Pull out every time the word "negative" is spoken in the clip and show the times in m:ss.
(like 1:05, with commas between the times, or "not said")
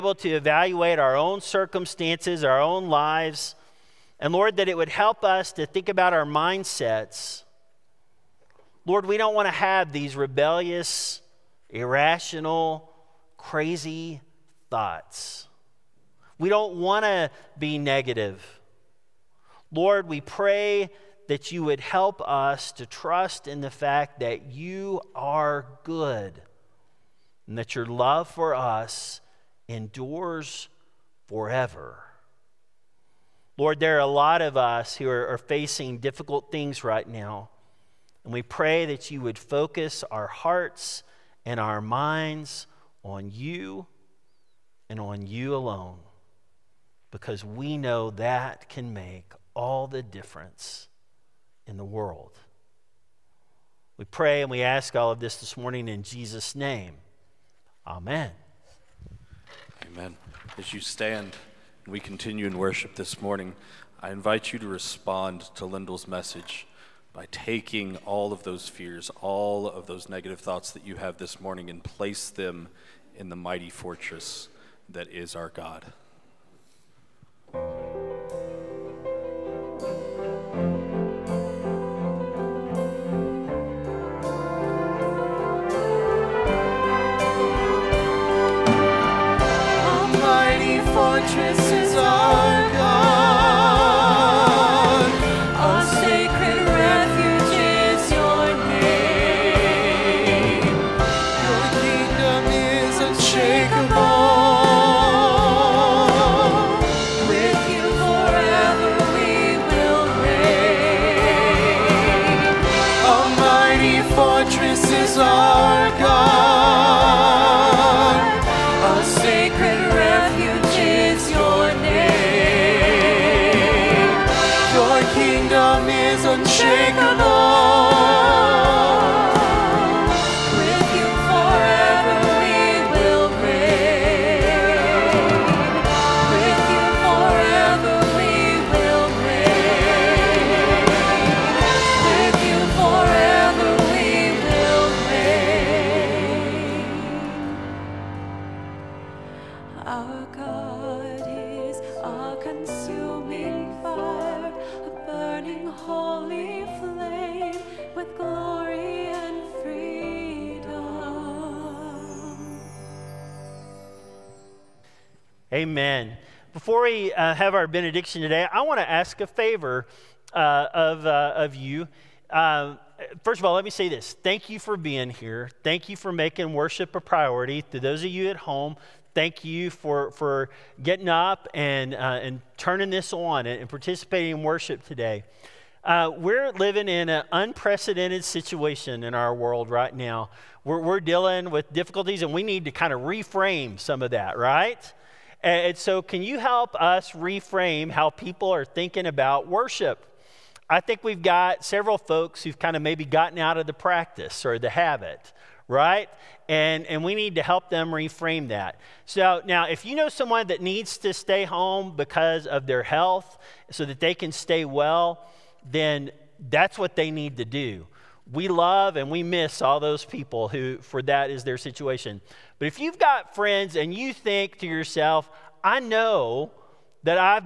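0:17, 1:10.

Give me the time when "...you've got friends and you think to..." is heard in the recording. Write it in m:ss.
3:42.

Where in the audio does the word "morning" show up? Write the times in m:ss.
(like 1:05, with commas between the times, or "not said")
0:55, 1:03, 1:11.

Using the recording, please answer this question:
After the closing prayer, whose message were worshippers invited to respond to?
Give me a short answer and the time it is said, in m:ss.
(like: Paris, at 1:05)
Lyndall, at 1:05.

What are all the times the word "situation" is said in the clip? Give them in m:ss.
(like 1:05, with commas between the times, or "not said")
3:08, 3:41.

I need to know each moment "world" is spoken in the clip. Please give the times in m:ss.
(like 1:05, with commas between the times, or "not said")
0:51, 3:09.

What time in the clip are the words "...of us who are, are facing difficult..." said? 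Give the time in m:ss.
0:34.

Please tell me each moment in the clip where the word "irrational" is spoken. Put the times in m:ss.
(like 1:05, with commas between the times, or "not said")
0:11.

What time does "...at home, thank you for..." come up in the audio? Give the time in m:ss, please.
2:58.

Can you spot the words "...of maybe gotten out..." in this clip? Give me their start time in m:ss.
3:22.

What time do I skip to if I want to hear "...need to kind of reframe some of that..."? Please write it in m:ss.
3:12.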